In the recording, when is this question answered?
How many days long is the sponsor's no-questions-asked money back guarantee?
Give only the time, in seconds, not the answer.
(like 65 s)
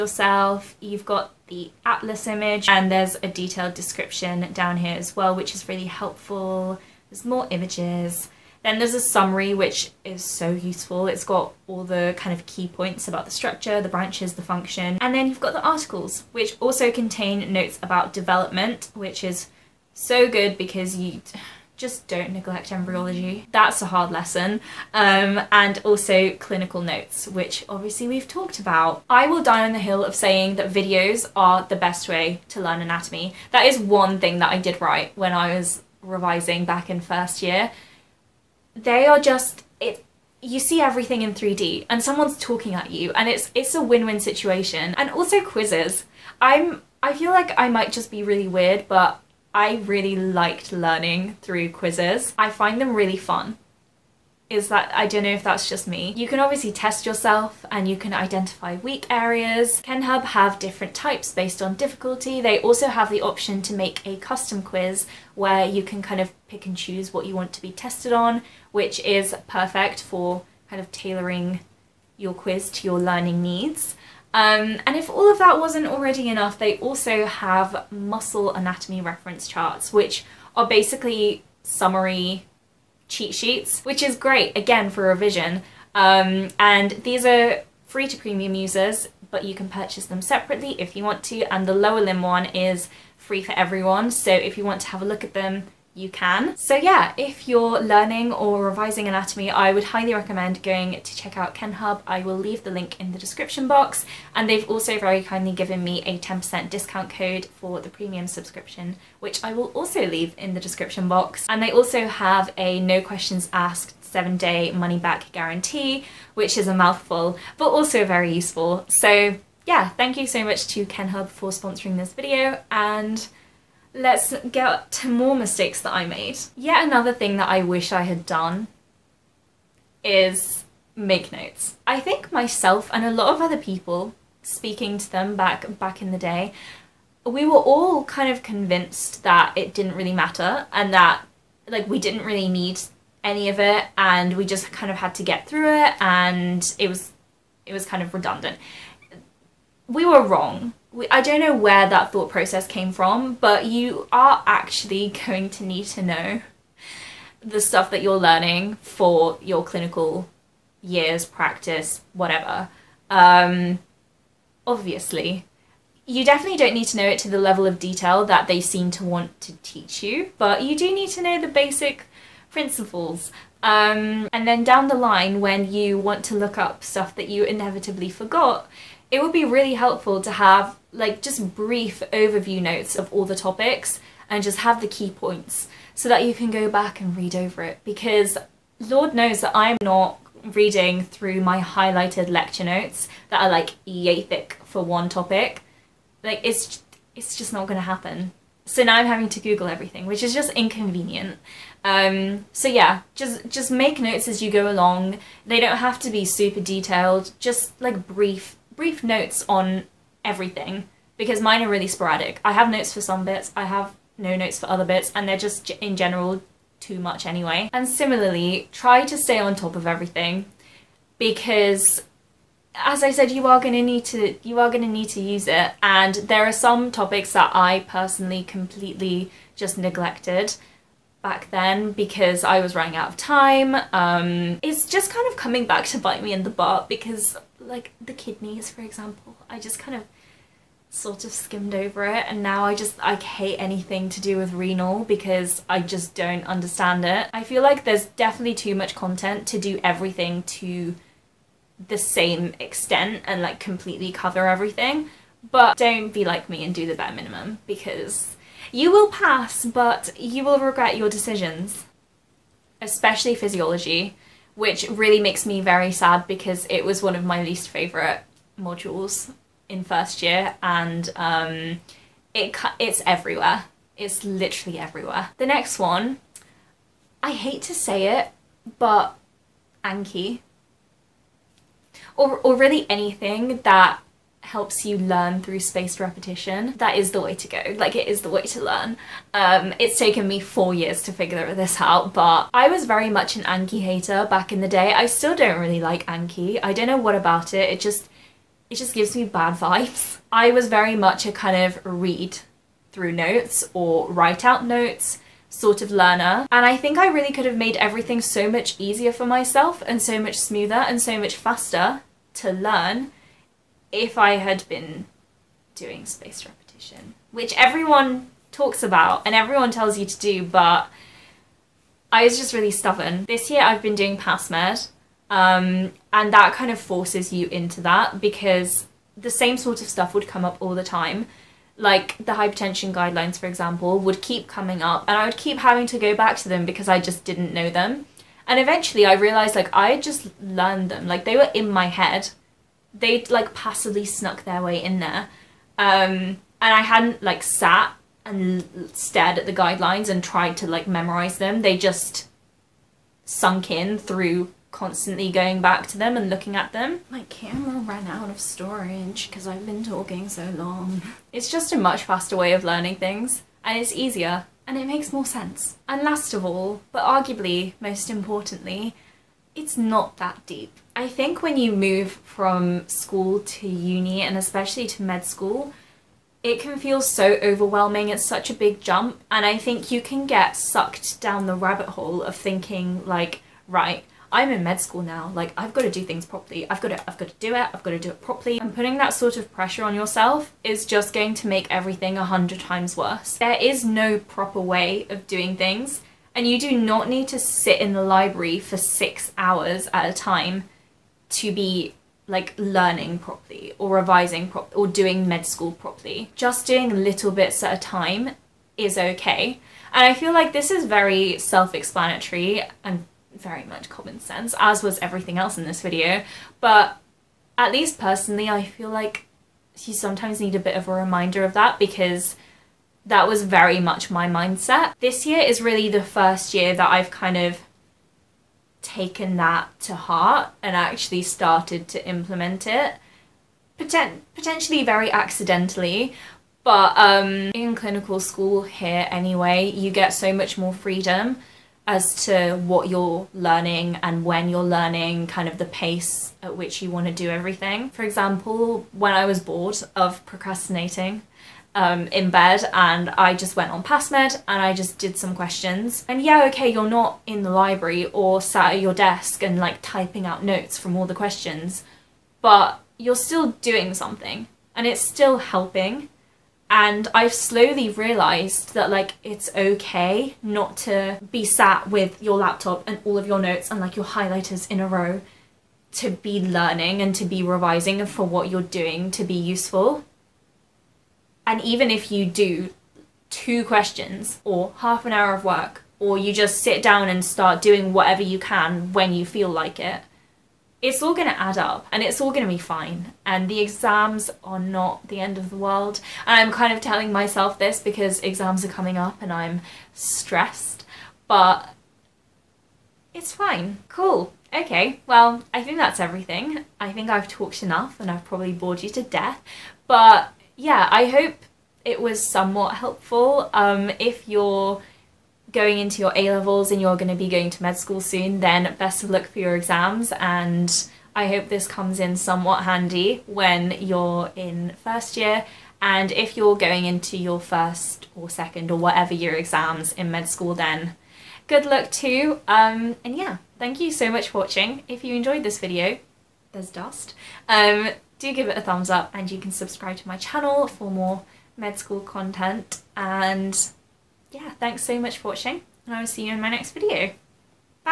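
114 s.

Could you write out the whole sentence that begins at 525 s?
And if you're going into your first or second or whatever year exams in med school, then good luck too.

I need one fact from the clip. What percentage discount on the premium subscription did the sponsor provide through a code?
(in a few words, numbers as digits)
10%.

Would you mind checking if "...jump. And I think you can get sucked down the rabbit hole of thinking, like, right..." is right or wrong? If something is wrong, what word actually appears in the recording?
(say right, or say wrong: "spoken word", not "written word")
right.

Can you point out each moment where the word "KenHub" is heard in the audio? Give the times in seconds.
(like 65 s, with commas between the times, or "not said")
59 s, 101 s, 120 s.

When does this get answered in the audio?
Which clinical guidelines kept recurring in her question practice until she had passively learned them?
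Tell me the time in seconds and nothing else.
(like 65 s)
332 s.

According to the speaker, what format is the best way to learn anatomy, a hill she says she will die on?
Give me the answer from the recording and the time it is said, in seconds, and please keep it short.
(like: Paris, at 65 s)
Videos, at 30 s.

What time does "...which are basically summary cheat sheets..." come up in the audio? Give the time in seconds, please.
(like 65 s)
79 s.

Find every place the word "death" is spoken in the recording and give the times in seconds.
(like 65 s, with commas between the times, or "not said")
509 s.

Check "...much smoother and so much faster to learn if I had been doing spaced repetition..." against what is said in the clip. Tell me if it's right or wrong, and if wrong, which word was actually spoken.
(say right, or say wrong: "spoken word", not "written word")
right.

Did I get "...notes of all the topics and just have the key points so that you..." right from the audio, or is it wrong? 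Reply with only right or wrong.
right.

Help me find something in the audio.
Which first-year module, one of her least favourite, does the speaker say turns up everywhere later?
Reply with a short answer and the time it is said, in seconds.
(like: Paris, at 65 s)
Physiology, at 263 s.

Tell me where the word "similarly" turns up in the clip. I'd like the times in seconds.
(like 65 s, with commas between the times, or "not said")
217 s.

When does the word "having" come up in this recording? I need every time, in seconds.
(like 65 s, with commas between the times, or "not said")
199 s, 335 s.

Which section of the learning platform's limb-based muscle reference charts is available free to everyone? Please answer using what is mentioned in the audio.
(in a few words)
Lower limb.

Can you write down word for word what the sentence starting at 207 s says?
Just like brief brief notes on everything because mine are really sporadic.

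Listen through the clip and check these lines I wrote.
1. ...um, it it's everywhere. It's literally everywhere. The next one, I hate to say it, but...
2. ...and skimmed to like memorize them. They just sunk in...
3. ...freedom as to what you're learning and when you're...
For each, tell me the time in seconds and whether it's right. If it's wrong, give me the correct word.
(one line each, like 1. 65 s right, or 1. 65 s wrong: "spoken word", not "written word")
1. 271 s right
2. 350 s wrong: "tried", not "skimmed"
3. 440 s right.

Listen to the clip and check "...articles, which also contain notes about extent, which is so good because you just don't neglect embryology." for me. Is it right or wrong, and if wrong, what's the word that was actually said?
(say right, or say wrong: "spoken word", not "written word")
wrong: "development", not "extent".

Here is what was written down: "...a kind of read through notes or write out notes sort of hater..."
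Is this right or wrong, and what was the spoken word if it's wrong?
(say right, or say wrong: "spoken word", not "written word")
wrong: "learner", not "hater".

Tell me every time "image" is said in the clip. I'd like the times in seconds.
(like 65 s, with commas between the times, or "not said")
2 s, 7 s.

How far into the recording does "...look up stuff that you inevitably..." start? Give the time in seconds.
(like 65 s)
176 s.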